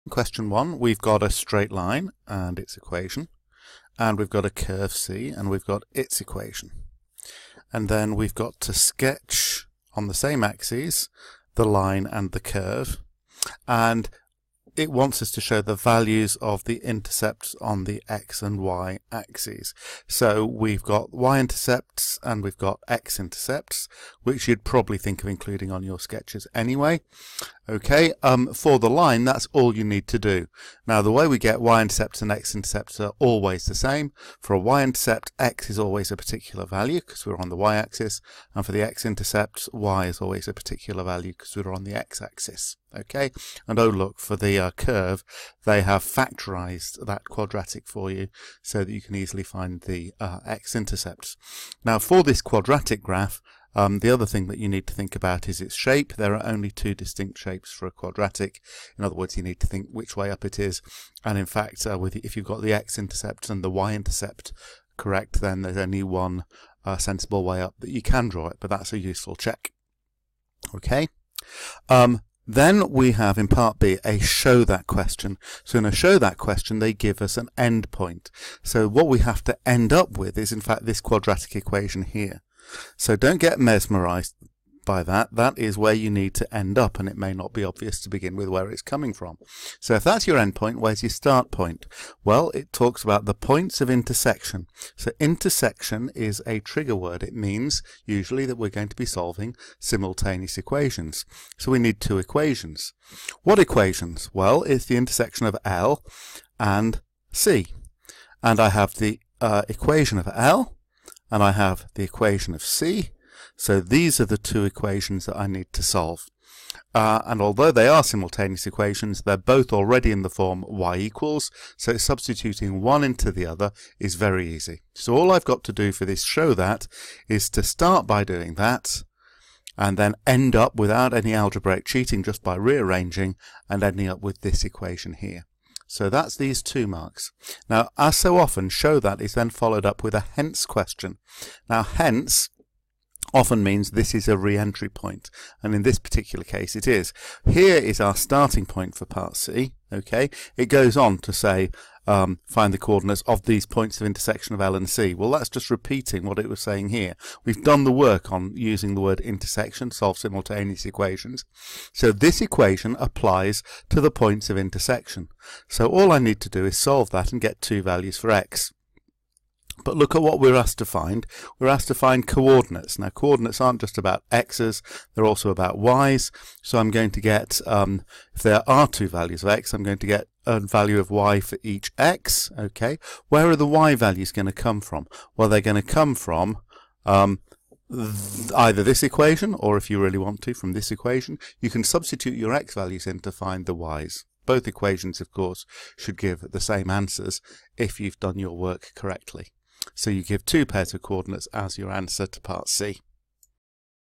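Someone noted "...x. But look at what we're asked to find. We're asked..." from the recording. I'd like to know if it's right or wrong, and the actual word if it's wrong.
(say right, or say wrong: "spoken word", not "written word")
right.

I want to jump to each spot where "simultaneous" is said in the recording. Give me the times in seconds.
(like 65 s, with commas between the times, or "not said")
99 s, 118 s, 160 s.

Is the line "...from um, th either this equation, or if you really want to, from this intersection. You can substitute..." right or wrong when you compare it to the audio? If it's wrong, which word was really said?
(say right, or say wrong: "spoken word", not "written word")
wrong: "equation", not "intersection".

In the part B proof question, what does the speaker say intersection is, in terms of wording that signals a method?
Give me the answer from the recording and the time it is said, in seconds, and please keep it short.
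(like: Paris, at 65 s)
A trigger word, at 96 s.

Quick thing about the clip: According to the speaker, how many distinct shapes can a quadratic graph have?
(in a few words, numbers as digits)
2.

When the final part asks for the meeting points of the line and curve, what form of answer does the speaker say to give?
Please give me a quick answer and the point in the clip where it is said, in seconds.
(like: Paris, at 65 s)
Two pairs of coordinates, at 200 s.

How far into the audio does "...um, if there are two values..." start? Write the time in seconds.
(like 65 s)
177 s.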